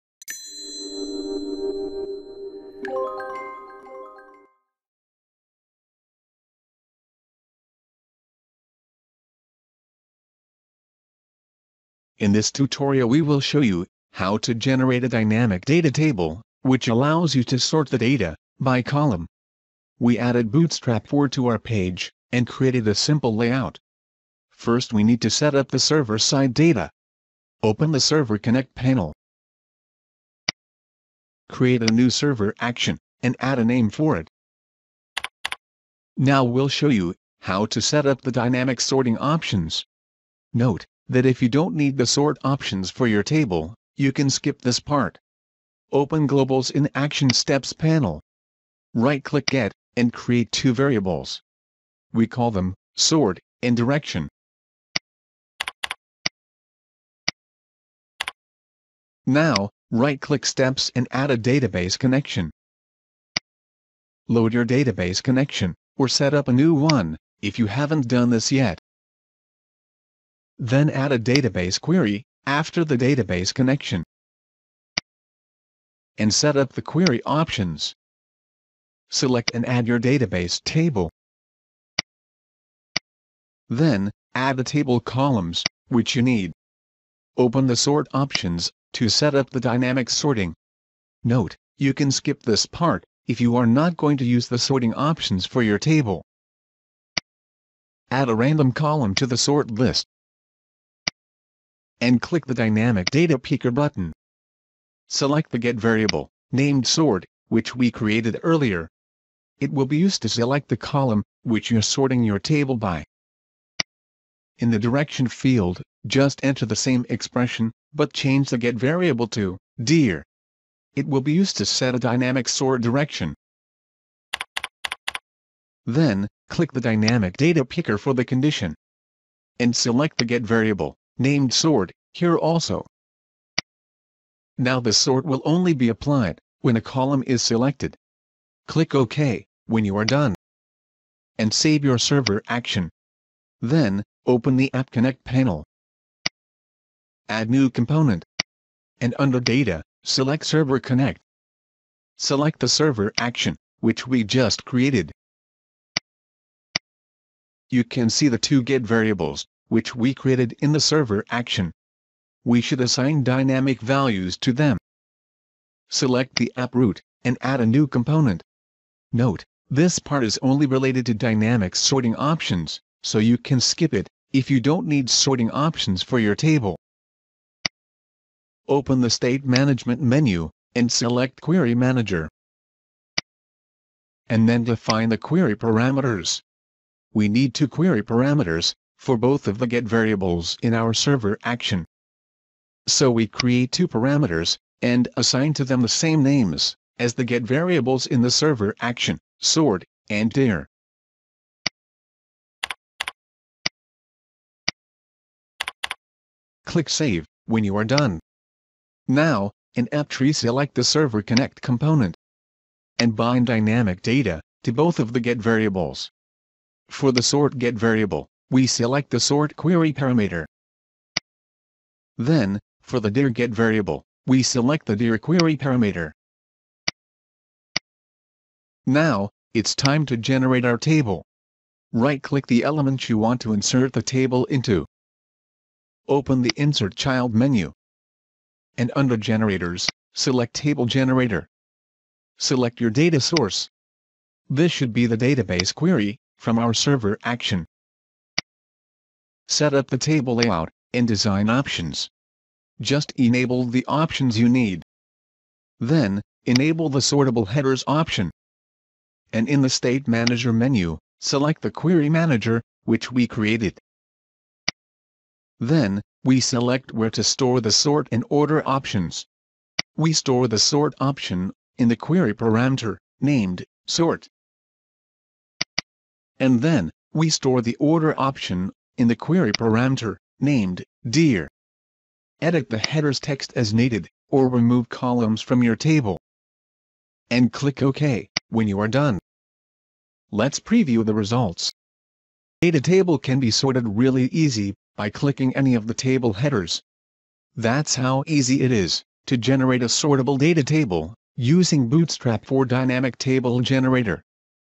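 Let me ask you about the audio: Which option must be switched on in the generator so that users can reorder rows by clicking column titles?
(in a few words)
Sortable Headers.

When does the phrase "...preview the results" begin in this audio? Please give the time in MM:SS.
04:50.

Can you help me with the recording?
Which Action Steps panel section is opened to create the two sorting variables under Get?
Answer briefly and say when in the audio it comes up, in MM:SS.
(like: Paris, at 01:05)
Globals, at 00:46.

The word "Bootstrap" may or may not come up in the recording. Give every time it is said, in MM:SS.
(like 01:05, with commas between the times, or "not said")
00:20, 05:01.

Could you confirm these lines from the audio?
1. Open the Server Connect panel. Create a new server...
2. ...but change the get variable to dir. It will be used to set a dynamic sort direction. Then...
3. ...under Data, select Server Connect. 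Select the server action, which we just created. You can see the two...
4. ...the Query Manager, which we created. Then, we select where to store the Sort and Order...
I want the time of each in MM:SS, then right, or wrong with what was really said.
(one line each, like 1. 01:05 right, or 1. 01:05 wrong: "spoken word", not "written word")
1. 00:27 right
2. 01:57 right
3. 02:29 right
4. 04:21 right.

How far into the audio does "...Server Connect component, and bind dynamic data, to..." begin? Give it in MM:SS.
03:30.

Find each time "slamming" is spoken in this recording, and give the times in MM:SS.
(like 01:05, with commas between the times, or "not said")
not said.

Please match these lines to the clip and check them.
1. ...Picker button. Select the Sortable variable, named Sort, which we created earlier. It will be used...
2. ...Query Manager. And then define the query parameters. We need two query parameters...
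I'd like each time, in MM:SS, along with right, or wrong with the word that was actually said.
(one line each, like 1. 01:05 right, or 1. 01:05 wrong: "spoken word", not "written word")
1. 01:43 wrong: "Get", not "Sortable"
2. 03:01 right.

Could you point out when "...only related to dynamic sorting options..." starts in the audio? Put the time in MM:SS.
02:50.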